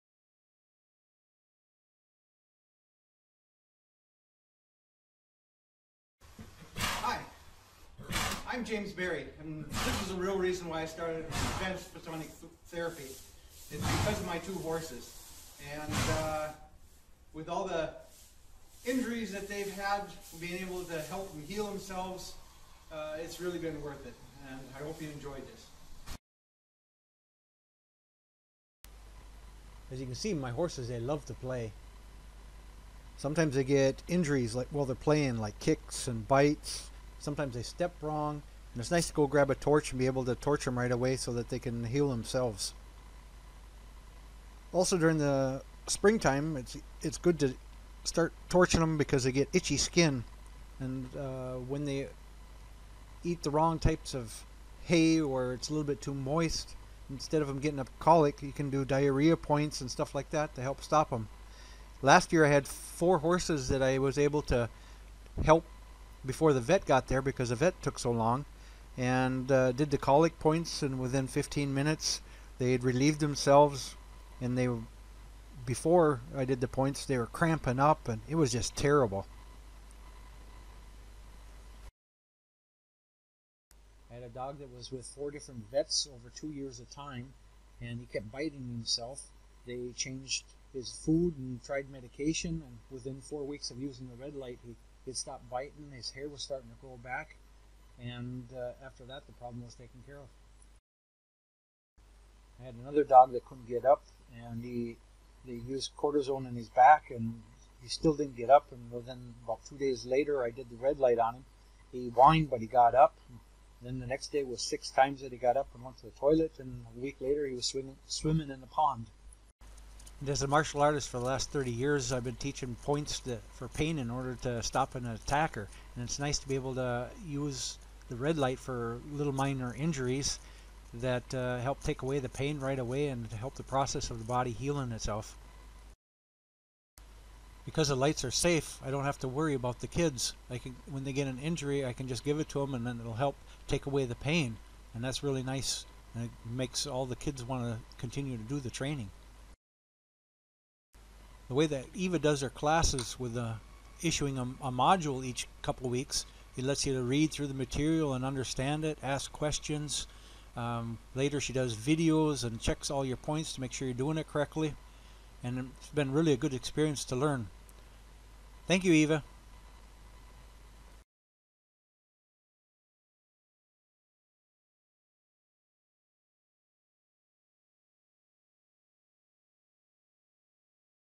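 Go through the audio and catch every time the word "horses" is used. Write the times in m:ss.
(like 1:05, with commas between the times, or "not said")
0:14, 0:30, 1:03.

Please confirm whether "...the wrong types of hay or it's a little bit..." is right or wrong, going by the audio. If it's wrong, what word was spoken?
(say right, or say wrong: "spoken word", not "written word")
right.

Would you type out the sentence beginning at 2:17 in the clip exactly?
Because the lights are safe, I don't have to worry about the kids.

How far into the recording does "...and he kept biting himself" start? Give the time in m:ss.
1:27.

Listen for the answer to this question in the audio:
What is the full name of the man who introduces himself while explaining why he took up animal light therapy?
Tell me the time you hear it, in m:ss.
0:08.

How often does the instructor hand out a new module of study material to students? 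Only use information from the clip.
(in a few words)
Each couple of weeks.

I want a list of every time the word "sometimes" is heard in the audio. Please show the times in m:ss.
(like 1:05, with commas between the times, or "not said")
0:33, 0:37.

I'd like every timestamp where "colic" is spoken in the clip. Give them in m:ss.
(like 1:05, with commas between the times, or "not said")
0:57, 1:09.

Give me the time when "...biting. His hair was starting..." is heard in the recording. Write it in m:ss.
1:35.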